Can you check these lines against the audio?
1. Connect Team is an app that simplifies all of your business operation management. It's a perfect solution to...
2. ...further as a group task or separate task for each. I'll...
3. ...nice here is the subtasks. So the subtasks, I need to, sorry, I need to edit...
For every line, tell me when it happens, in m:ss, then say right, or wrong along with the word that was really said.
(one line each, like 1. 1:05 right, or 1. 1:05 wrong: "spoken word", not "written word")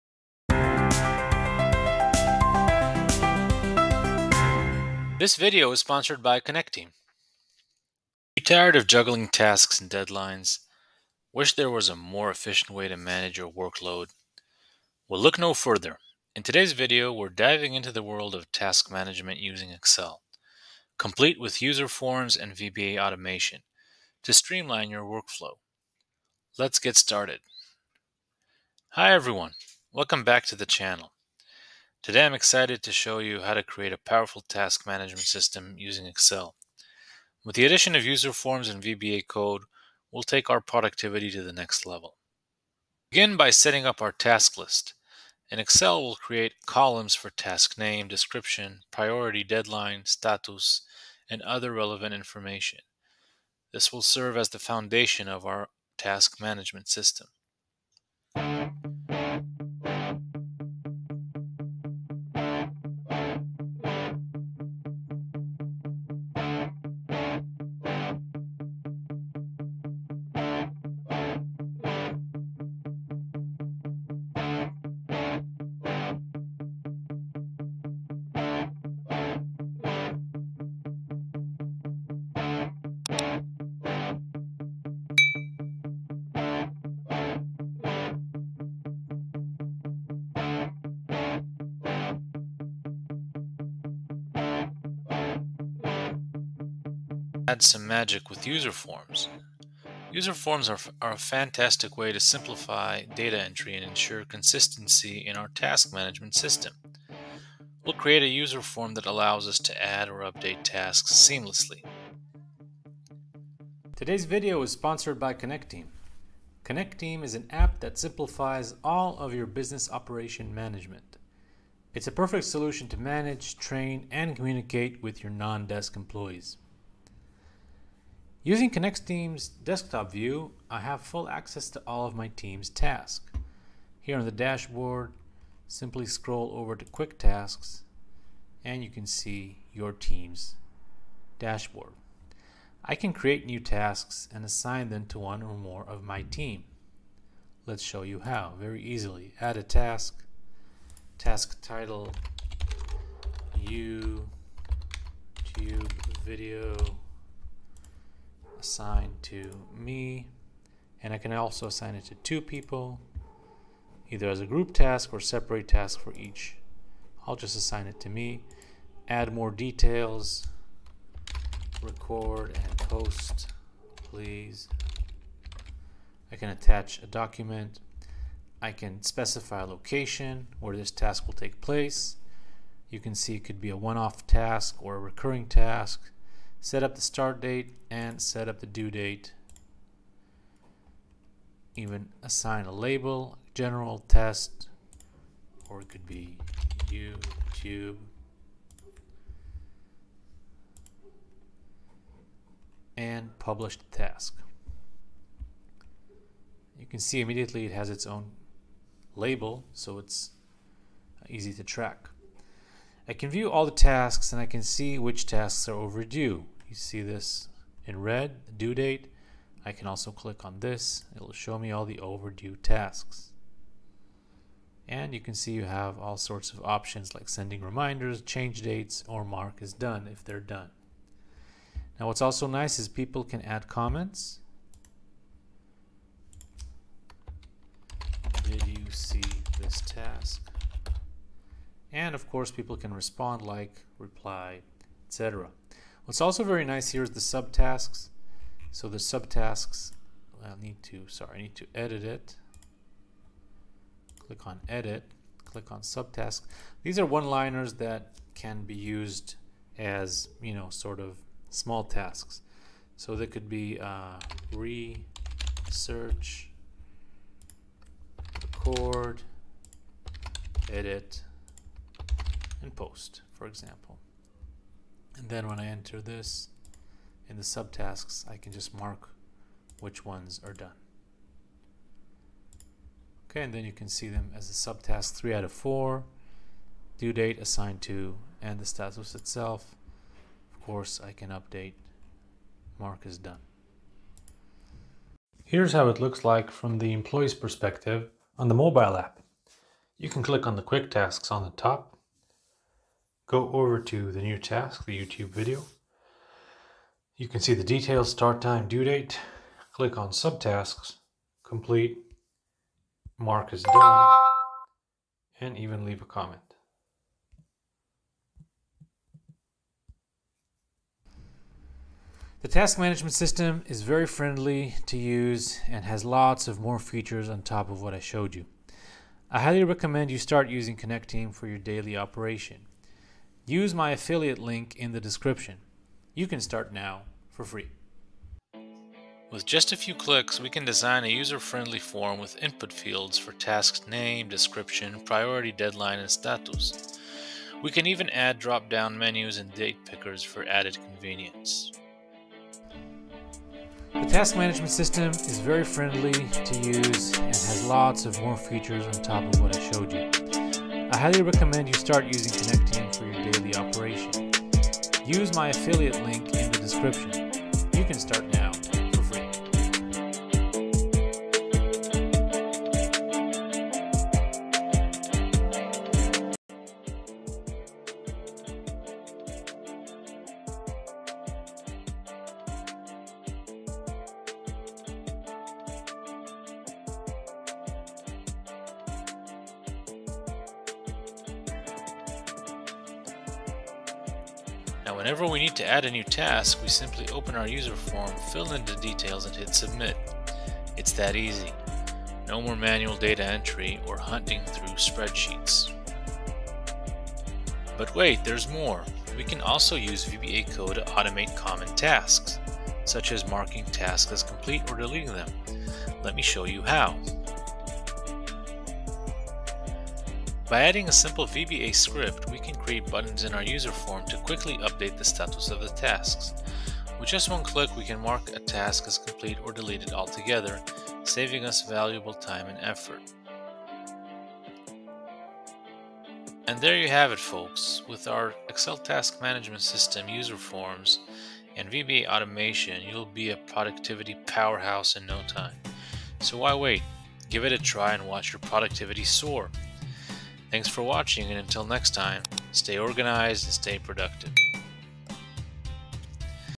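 1. 1:56 right
2. 2:44 wrong: "either", not "further"
3. 4:06 right.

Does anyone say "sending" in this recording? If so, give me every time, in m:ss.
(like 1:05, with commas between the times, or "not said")
3:47.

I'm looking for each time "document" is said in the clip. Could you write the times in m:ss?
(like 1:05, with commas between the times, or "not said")
2:57.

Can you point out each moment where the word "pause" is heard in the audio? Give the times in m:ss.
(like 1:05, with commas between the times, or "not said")
not said.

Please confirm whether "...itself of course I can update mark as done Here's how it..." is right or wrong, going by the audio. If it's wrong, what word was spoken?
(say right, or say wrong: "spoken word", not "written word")
right.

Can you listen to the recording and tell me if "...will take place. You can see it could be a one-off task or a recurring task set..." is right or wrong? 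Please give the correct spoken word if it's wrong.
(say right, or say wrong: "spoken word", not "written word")
right.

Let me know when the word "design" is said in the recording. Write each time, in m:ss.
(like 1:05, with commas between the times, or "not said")
5:40.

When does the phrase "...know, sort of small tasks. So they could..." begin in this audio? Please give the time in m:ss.
4:20.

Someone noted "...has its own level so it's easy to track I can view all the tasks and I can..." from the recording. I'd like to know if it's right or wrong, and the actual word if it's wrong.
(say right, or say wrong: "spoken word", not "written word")
wrong: "label", not "level".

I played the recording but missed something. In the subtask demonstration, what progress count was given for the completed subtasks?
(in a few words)
3 out of 4.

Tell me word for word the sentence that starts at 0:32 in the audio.
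Today I'm excited to show you how to create a powerful task management system using Excel.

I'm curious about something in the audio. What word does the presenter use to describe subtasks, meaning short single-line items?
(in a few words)
One-liners.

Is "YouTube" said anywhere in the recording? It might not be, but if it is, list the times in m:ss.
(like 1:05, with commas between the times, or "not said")
2:33, 3:16, 5:04.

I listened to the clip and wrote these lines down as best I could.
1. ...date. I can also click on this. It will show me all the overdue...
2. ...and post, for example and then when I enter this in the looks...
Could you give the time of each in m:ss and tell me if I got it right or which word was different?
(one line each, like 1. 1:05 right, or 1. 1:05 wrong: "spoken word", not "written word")
1. 3:38 right
2. 4:32 wrong: "subtasks", not "looks".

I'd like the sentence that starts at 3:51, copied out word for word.
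Now what's also nice is people can add comments.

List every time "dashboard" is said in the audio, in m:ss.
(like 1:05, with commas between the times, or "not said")
2:14, 2:21.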